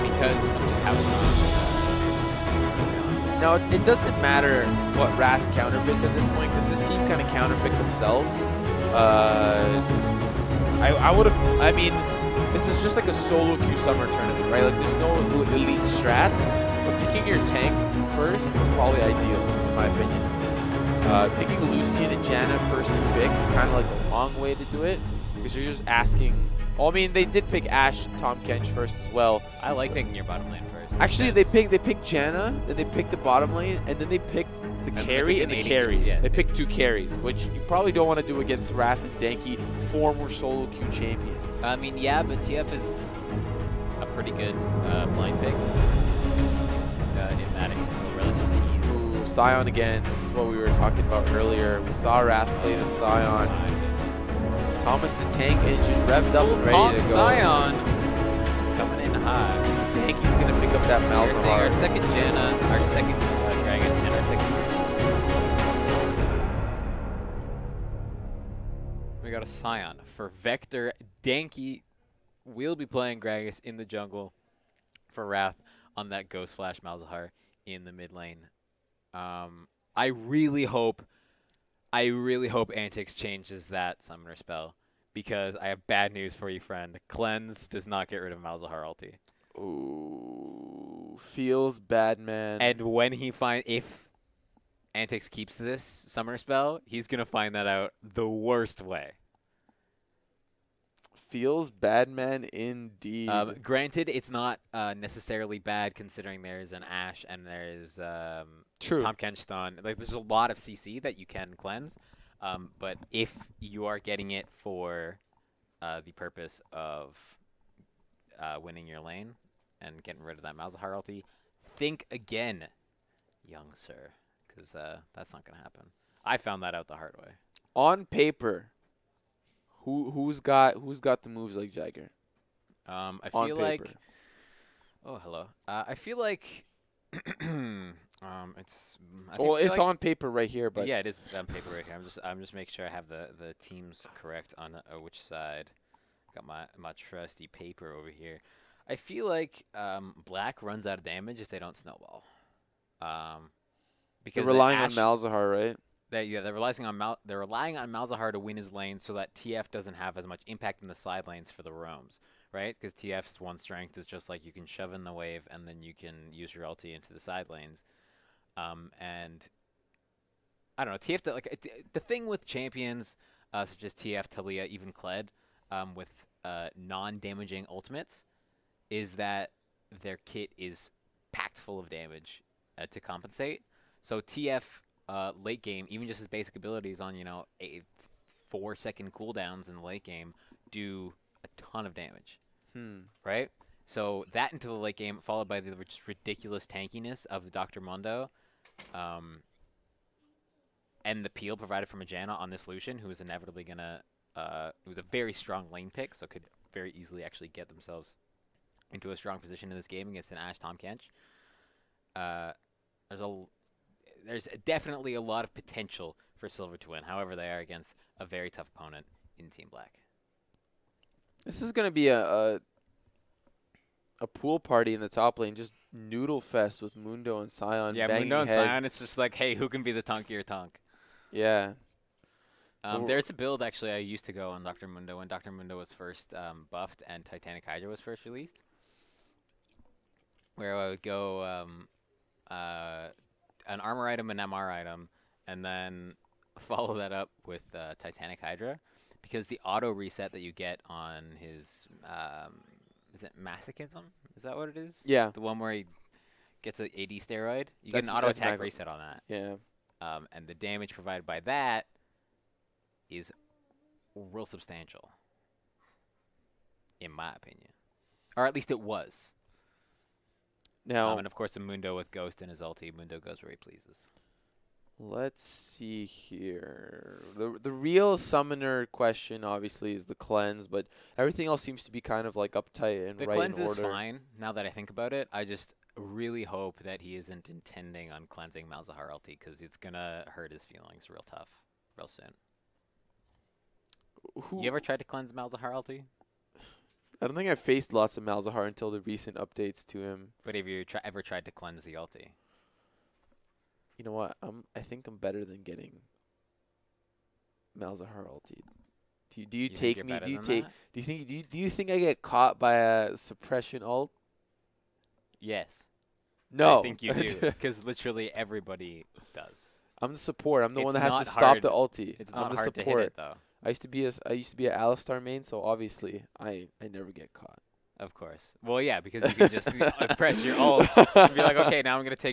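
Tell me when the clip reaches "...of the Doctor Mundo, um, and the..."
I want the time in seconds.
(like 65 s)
197 s.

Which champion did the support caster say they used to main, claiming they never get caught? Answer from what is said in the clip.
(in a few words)
Alistar.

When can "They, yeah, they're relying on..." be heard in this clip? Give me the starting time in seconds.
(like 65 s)
156 s.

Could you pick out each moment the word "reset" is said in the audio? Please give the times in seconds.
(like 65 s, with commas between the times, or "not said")
249 s, 258 s.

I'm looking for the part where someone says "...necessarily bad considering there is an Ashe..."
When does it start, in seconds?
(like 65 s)
104 s.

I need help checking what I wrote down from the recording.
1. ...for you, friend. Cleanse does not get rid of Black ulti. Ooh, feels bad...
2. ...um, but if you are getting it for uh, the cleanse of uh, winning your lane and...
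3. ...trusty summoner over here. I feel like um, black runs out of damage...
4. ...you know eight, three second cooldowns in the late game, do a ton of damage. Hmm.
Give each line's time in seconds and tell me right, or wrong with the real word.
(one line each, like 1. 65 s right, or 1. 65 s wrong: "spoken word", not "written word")
1. 86 s wrong: "Malzahar", not "Black"
2. 112 s wrong: "purpose", not "cleanse"
3. 146 s wrong: "paper", not "summoner"
4. 187 s wrong: "four", not "three".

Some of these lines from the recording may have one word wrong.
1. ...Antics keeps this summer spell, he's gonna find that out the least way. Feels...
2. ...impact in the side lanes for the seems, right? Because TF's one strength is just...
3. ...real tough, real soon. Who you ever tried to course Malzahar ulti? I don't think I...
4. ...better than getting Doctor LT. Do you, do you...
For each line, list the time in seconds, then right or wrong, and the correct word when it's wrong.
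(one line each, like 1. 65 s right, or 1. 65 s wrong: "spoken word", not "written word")
1. 94 s wrong: "worst", not "least"
2. 160 s wrong: "roams", not "seems"
3. 291 s wrong: "cleanse", not "course"
4. 305 s wrong: "Malzahar", not "Doctor".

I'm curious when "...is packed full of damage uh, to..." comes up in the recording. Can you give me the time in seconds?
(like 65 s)
180 s.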